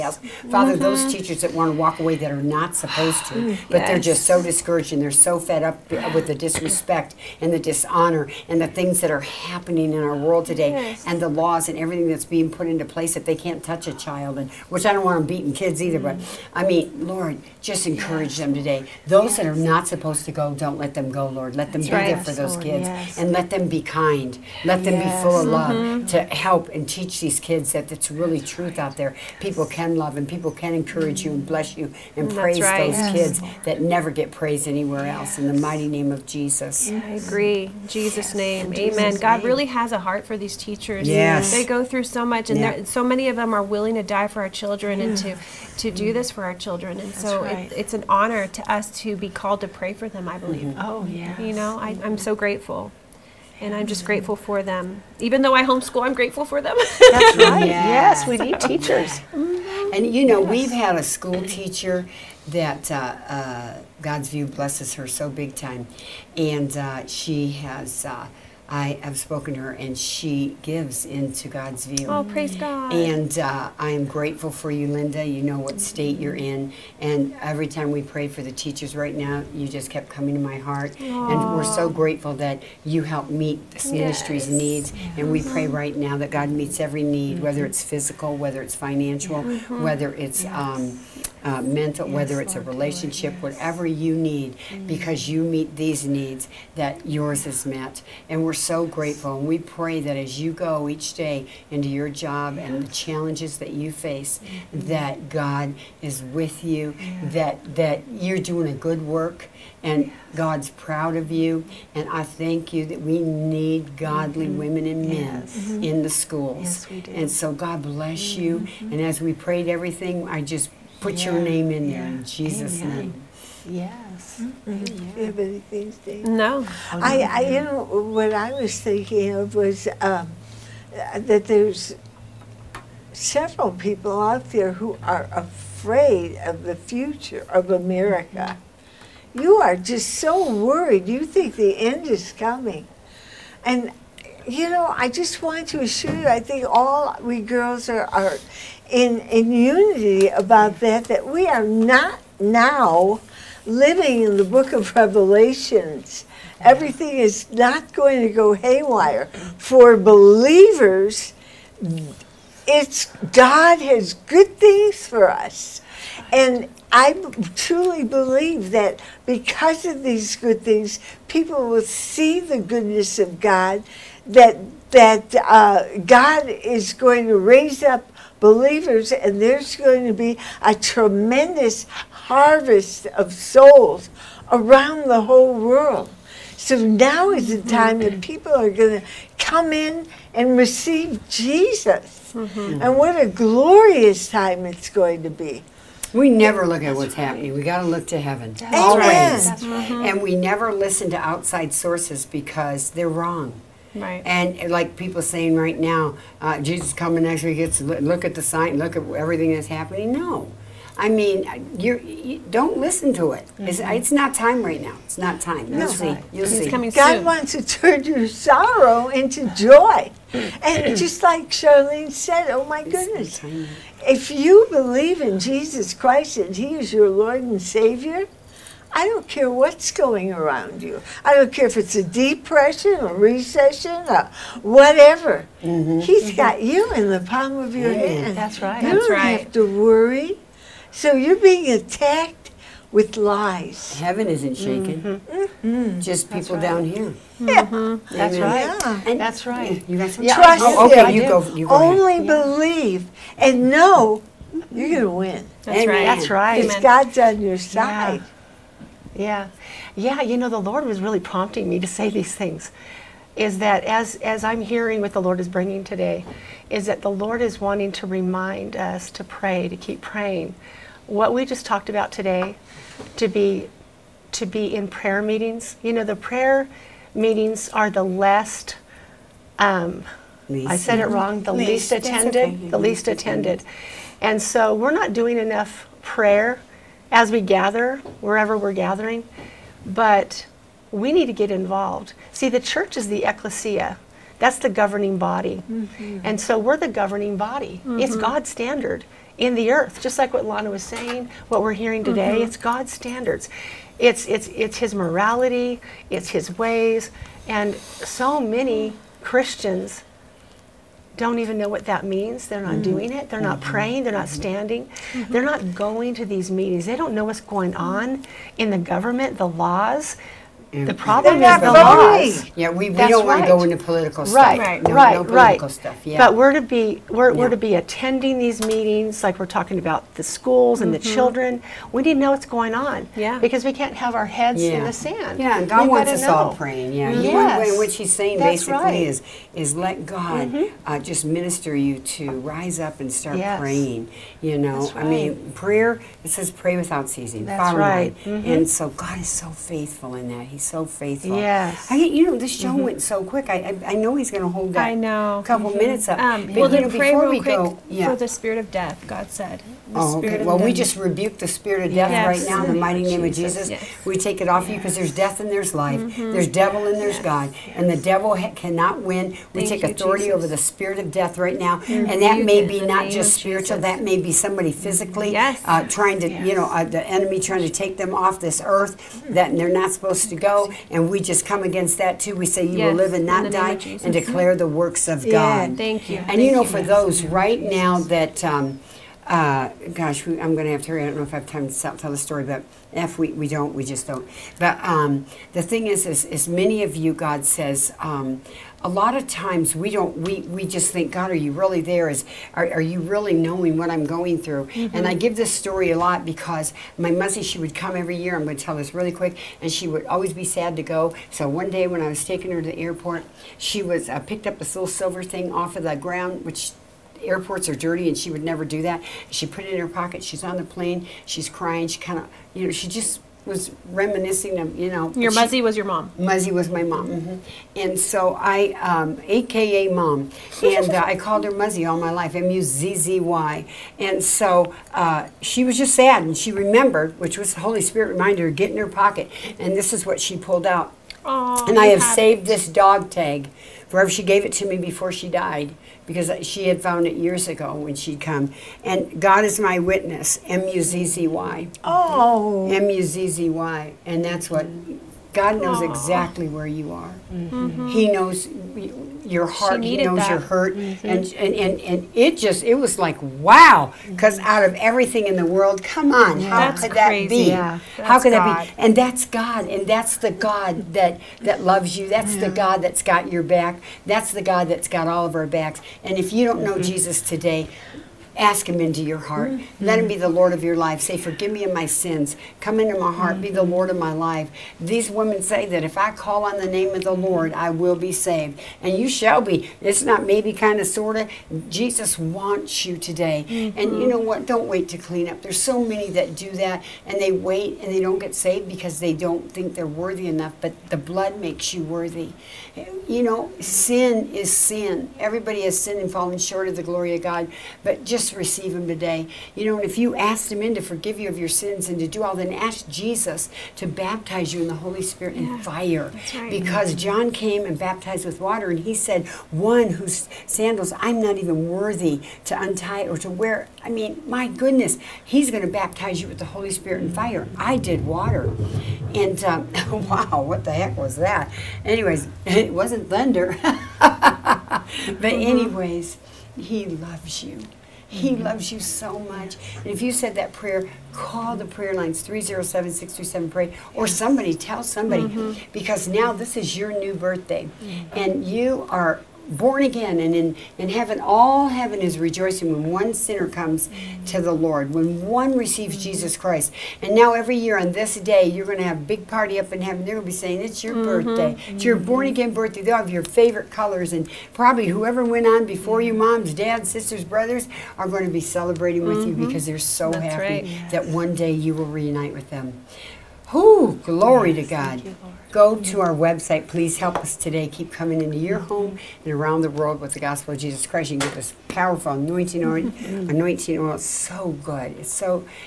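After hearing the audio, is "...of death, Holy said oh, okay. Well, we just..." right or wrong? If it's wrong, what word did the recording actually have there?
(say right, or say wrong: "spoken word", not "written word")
wrong: "God", not "Holy".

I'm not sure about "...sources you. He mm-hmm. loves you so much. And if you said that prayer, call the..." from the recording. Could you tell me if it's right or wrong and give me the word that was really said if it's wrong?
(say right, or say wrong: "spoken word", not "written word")
wrong: "loves", not "sources".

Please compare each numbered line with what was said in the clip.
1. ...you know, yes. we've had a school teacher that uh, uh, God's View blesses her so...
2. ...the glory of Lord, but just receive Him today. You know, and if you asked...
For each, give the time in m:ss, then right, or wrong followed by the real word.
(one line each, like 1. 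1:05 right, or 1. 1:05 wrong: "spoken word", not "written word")
1. 1:00 right
2. 8:26 wrong: "God", not "Lord".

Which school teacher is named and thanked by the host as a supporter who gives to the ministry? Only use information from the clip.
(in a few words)
Linda.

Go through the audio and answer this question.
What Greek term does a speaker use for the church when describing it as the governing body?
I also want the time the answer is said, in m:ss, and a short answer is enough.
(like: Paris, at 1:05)
ecclesia, at 4:53.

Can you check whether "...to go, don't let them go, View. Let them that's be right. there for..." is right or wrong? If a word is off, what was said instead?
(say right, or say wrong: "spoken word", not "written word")
wrong: "Lord", not "View".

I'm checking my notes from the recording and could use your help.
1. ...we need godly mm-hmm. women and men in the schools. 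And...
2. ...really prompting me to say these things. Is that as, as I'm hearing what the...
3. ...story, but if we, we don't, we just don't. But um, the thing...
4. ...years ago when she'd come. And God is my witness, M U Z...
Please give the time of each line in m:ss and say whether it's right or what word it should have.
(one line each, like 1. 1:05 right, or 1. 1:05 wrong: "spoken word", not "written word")
1. 1:53 right
2. 4:21 right
3. 6:32 right
4. 7:27 right.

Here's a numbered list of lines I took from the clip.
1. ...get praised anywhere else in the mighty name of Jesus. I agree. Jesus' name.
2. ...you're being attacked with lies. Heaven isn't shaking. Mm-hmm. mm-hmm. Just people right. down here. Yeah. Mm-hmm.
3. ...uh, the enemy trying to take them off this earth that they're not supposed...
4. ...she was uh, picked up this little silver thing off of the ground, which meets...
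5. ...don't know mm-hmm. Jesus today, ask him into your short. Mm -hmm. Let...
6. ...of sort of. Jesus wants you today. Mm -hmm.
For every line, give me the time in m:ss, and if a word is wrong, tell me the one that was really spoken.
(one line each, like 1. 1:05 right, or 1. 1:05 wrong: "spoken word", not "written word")
1. 0:34 right
2. 4:01 right
3. 6:16 right
4. 6:53 wrong: "airports", not "meets"
5. 7:56 wrong: "heart", not "short"
6. 8:10 right.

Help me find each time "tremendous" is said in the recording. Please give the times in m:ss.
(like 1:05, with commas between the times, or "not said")
3:00.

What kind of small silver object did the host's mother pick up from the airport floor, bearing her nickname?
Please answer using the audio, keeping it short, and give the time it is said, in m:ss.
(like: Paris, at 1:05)
dog tag, at 7:22.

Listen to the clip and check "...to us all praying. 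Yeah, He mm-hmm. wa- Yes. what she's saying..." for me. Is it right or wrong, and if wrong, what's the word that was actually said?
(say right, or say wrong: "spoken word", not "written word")
right.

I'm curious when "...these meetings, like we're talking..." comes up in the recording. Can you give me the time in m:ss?
5:28.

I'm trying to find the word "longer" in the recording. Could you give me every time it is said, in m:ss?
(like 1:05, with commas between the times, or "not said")
not said.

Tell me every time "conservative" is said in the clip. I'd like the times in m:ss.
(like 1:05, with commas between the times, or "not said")
not said.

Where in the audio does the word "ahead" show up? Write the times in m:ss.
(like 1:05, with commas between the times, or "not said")
4:12.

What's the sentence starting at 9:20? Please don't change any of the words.
They're going to be saying, it's your mm -hmm.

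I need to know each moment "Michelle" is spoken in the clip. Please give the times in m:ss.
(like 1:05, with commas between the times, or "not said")
not said.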